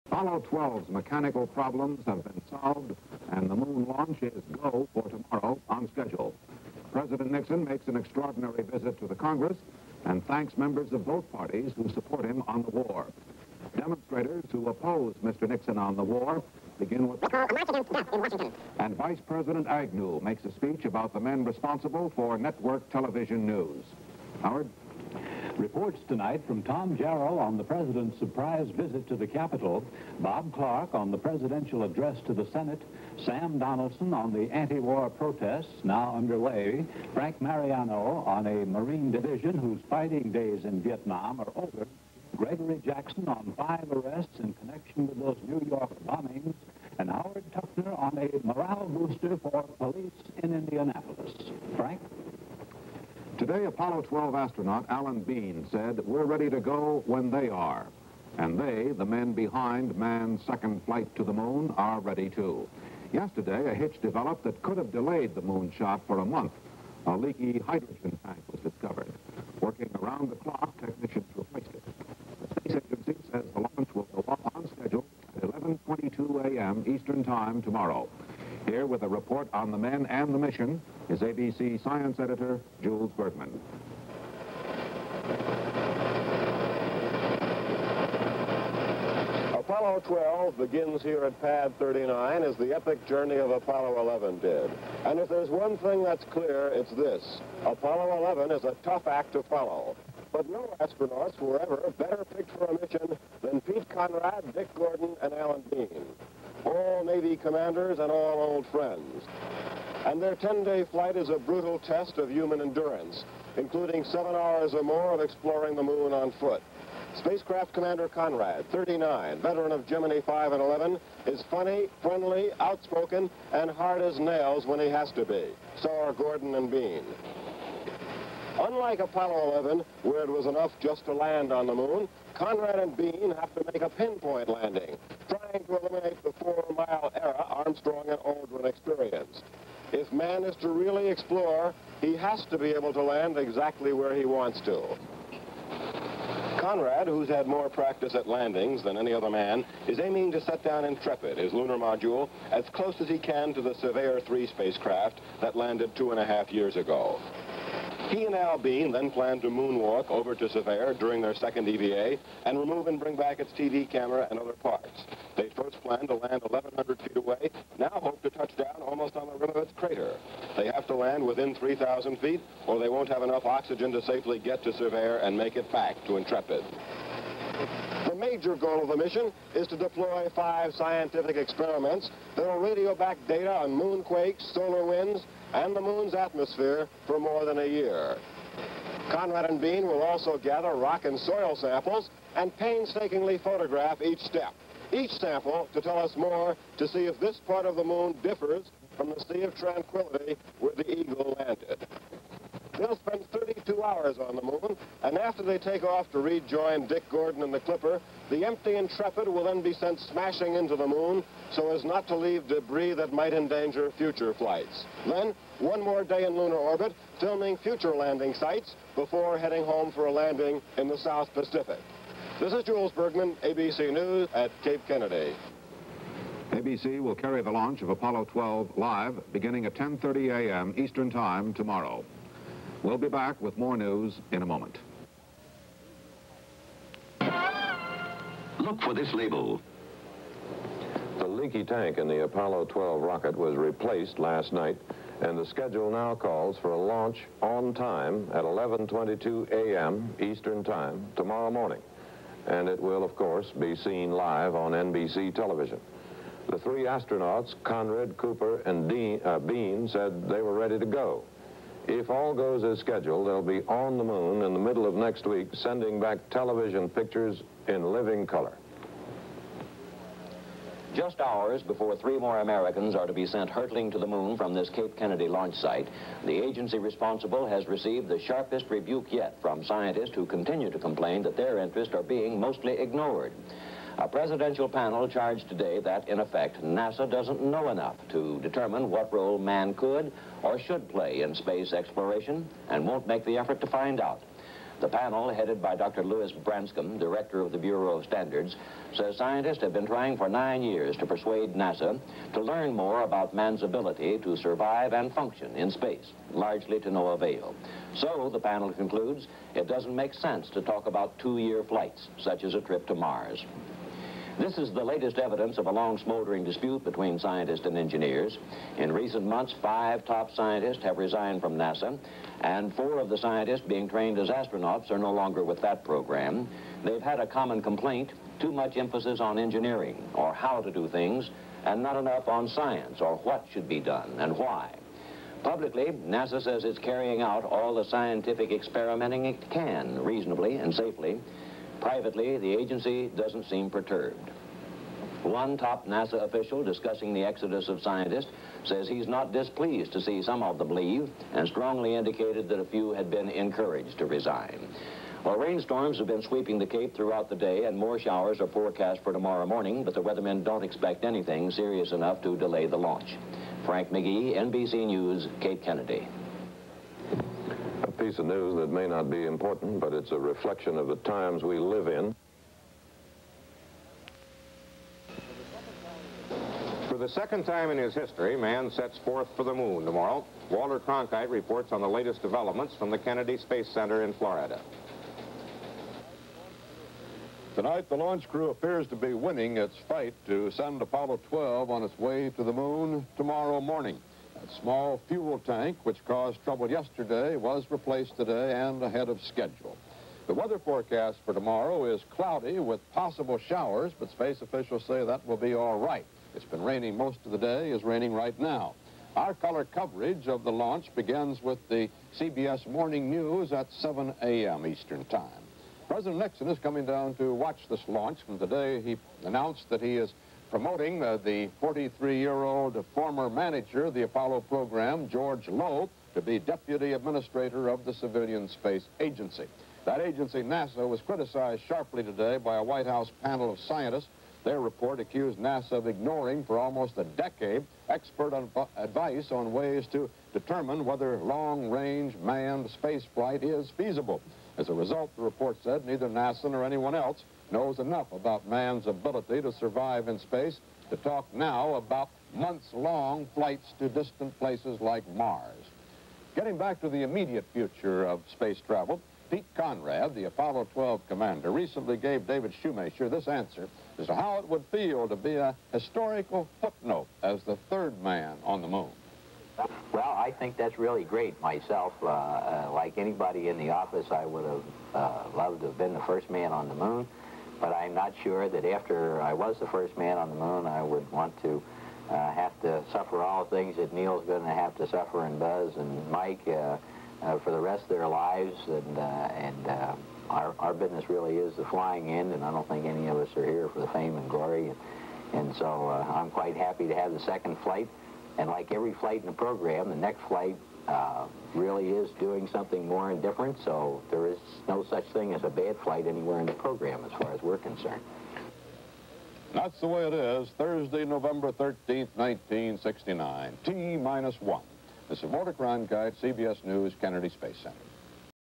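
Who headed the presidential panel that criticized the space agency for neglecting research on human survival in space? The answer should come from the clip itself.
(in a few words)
Lewis Branscomb.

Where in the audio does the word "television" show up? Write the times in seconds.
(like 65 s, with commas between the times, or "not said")
22 s, 255 s, 266 s.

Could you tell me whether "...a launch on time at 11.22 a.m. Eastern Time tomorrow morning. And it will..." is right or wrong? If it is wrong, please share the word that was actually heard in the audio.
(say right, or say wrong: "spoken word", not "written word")
right.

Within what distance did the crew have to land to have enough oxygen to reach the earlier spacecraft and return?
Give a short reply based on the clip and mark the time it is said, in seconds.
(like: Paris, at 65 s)
3,000 feet, at 171 s.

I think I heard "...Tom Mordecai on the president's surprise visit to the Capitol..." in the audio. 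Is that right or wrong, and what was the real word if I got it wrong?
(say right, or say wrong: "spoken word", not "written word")
wrong: "Jarriel", not "Mordecai".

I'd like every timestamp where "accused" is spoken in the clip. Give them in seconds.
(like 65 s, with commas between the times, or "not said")
434 s.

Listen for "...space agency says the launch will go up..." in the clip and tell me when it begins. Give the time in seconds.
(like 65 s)
72 s.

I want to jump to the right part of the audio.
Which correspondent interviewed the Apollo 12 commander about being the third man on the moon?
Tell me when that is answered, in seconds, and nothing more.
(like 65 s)
462 s.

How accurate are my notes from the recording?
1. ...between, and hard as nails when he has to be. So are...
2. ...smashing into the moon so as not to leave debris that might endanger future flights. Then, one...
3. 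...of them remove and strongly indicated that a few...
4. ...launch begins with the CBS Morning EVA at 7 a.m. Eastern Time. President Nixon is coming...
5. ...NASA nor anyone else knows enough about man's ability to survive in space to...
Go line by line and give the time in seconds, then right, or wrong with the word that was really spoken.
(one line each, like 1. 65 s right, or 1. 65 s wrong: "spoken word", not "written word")
1. 122 s wrong: "outspoken", not "between"
2. 210 s right
3. 350 s wrong: "leave", not "remove"
4. 410 s wrong: "News", not "EVA"
5. 446 s right.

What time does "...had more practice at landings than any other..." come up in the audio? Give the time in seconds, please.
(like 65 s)
147 s.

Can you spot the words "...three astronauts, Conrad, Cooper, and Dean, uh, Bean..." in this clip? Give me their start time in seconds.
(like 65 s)
256 s.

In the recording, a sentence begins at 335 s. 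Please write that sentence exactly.
Publicly, NASA says it's carrying out all the scientific experimenting it can, reasonably and safely, Privately, the agency doesn't seem perturbed.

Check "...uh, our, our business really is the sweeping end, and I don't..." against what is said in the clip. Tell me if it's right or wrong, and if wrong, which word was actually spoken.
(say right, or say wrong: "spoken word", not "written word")
wrong: "flying", not "sweeping".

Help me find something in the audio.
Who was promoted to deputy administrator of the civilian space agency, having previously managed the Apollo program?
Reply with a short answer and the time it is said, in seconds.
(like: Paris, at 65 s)
George Low, at 425 s.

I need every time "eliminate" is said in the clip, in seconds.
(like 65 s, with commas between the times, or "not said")
135 s.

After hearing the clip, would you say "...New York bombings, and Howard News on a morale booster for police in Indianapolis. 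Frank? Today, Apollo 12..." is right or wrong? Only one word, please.
wrong.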